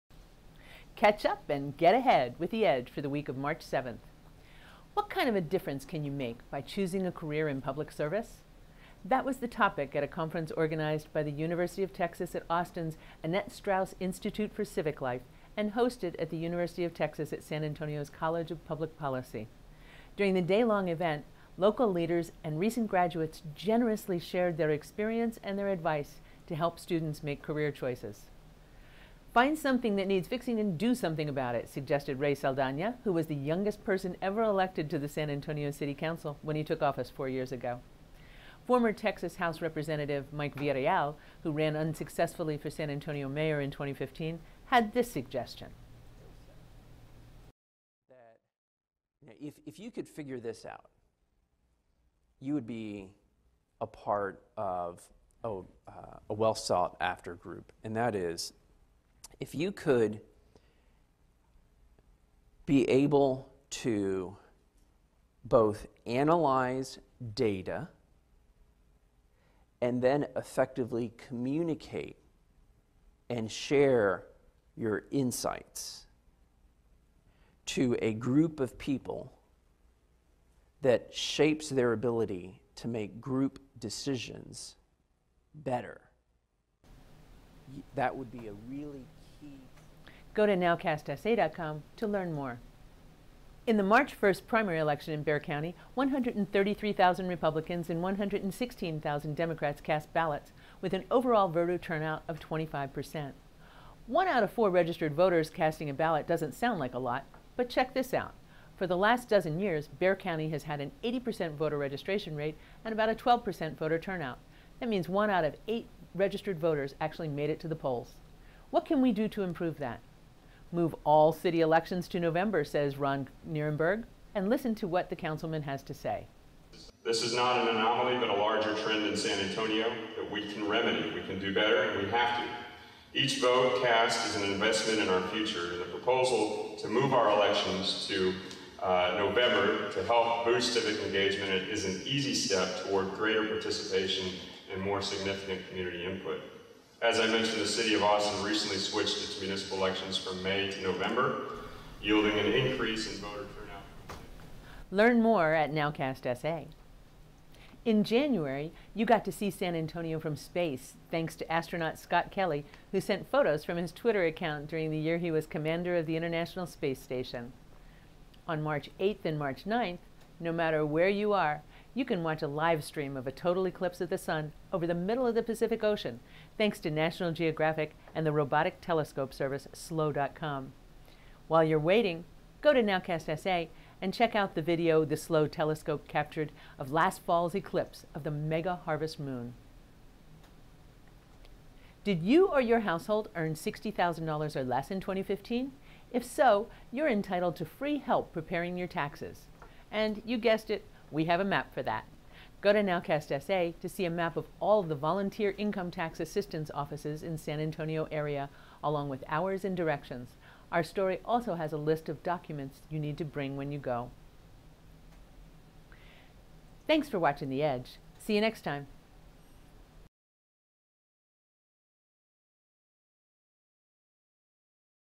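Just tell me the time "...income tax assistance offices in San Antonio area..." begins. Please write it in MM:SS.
03:25.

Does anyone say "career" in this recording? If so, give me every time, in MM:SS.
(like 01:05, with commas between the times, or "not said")
00:07, 00:27.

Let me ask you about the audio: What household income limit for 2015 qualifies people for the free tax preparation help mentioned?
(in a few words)
$60,000.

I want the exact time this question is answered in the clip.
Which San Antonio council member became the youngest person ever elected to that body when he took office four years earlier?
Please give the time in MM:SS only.
00:32.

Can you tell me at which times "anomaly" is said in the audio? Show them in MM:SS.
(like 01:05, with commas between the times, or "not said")
02:07.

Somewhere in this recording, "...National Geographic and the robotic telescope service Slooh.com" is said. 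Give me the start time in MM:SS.
02:56.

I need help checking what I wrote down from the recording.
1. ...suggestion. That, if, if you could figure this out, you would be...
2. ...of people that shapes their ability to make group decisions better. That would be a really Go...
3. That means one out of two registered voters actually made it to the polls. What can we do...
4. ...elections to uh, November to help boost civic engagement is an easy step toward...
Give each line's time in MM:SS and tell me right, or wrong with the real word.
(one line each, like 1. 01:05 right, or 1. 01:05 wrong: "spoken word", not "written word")
1. 00:45 right
2. 01:18 right
3. 01:54 wrong: "eight", not "two"
4. 02:17 right.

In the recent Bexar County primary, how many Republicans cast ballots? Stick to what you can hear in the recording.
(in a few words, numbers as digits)
133,000.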